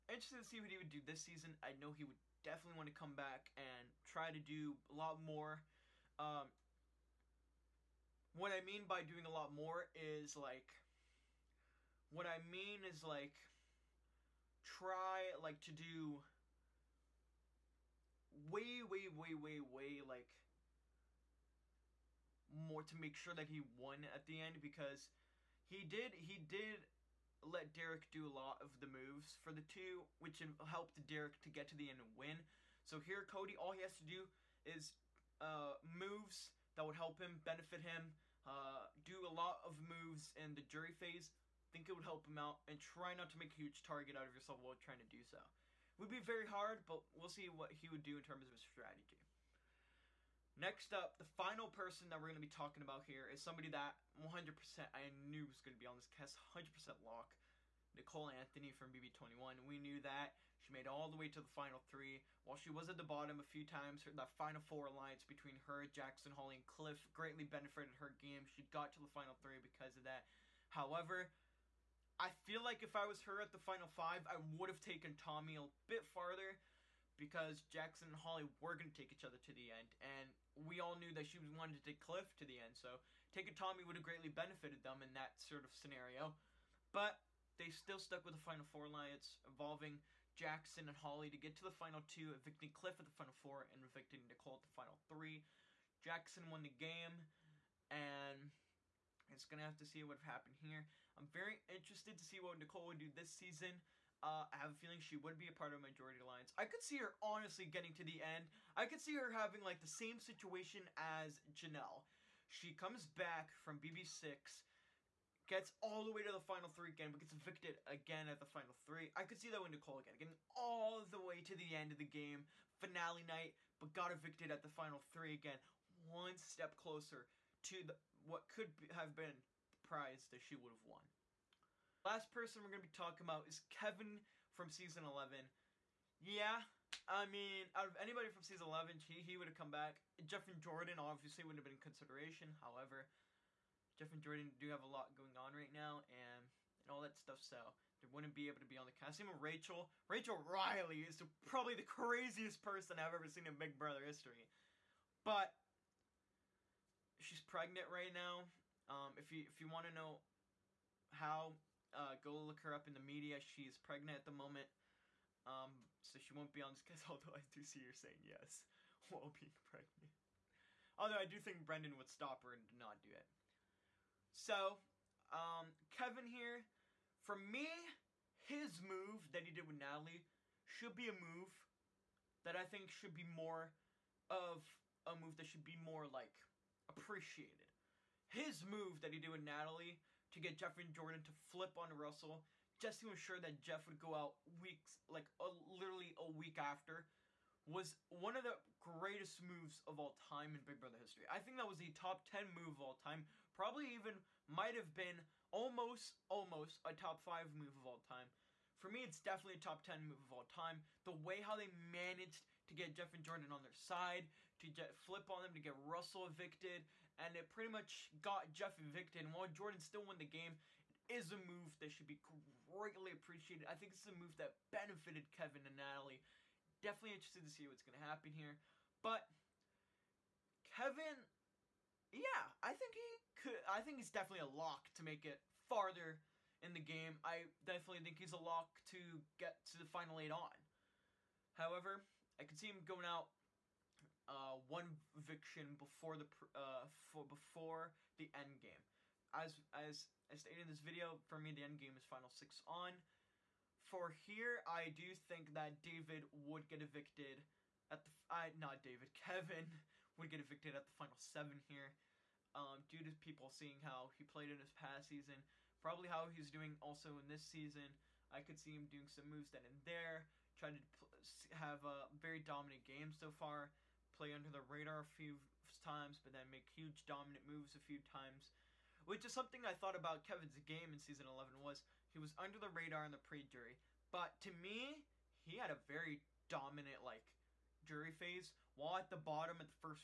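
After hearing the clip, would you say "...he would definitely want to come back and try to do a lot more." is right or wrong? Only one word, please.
right.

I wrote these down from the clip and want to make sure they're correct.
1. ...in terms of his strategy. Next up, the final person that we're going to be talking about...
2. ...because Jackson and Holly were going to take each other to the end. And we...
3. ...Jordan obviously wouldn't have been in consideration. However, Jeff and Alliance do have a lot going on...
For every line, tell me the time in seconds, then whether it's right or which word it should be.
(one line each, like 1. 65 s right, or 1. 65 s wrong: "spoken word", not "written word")
1. 48 s right
2. 77 s right
3. 140 s wrong: "Jordan", not "Alliance".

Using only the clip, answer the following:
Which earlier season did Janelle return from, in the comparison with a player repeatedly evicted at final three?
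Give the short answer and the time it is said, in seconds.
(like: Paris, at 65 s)
BB6, at 113 s.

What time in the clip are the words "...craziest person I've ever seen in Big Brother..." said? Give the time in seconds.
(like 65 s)
151 s.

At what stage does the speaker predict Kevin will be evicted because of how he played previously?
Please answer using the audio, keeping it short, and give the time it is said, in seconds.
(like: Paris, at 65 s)
Final seven, at 260 s.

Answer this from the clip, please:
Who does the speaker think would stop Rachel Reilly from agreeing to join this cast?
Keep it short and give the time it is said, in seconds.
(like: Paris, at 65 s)
Brendan, at 171 s.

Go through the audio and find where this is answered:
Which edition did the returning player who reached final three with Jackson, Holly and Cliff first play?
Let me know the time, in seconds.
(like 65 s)
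58 s.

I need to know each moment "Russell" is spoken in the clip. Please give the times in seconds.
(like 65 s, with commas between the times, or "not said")
191 s, 215 s.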